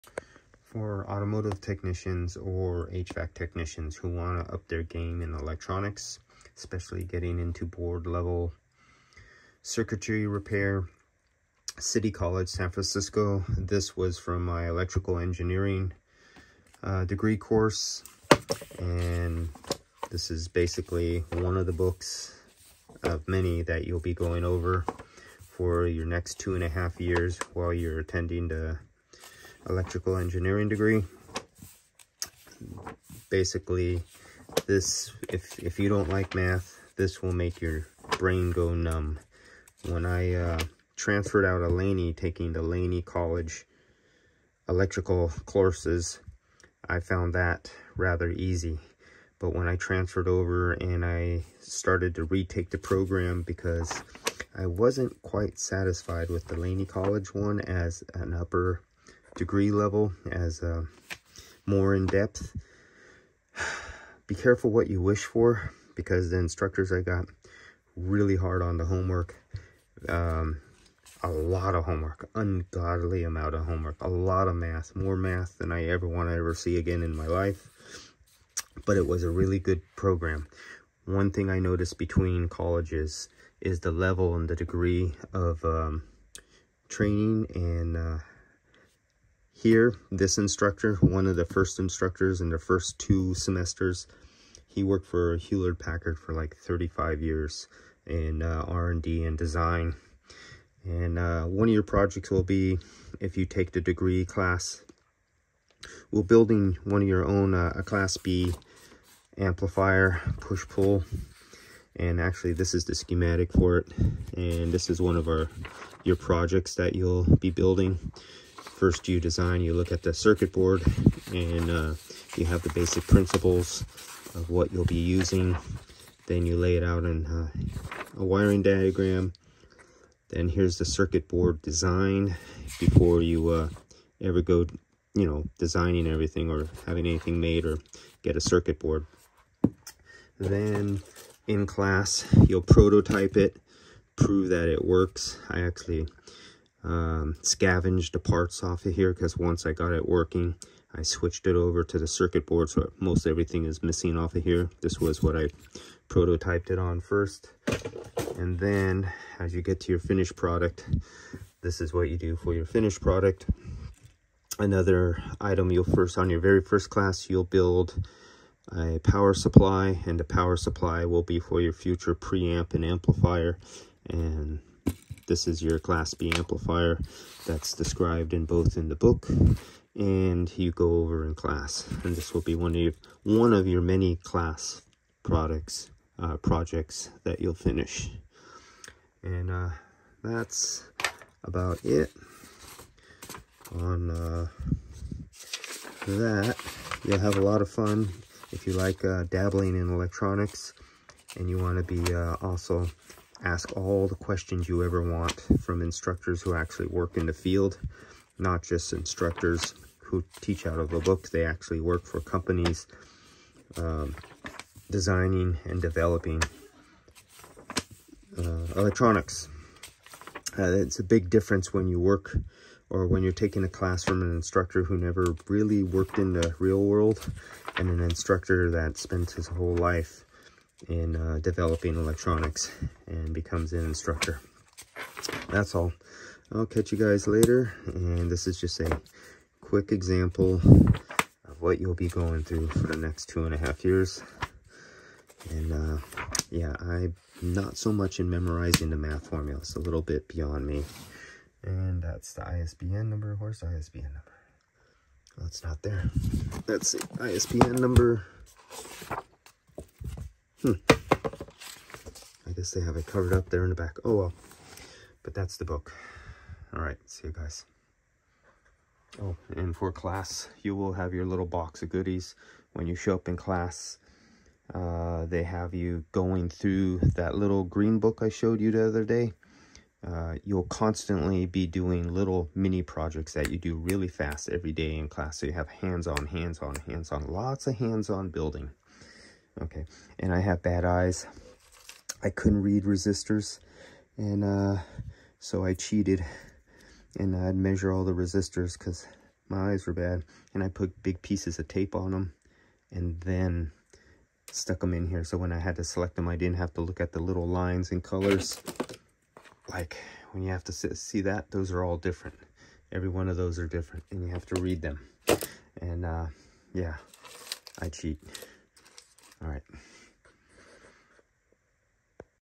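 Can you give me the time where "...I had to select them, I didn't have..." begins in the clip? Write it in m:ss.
5:05.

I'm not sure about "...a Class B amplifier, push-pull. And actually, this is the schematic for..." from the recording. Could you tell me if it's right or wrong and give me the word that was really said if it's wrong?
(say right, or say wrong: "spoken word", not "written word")
right.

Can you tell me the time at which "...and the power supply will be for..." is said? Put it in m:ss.
2:50.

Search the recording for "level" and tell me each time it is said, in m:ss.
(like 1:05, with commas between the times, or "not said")
0:08, 0:59, 1:23.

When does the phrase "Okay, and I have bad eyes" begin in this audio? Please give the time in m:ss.
4:49.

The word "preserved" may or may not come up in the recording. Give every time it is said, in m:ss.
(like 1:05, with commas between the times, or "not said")
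not said.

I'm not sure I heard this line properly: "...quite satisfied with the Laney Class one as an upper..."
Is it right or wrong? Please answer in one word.
wrong.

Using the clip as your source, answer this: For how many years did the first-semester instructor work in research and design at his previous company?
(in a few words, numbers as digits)
35.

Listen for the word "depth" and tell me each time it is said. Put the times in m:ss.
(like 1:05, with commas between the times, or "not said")
1:02.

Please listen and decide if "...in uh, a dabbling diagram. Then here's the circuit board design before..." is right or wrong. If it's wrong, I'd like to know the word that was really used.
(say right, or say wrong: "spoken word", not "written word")
wrong: "wiring", not "dabbling".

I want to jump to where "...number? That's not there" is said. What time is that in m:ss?
4:14.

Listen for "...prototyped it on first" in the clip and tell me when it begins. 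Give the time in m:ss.
2:36.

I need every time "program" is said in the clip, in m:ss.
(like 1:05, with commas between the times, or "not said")
0:52, 1:19.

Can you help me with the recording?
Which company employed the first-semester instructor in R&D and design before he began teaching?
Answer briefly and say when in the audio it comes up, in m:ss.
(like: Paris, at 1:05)
Hewlett Packard, at 1:35.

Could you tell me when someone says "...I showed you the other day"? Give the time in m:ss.
4:38.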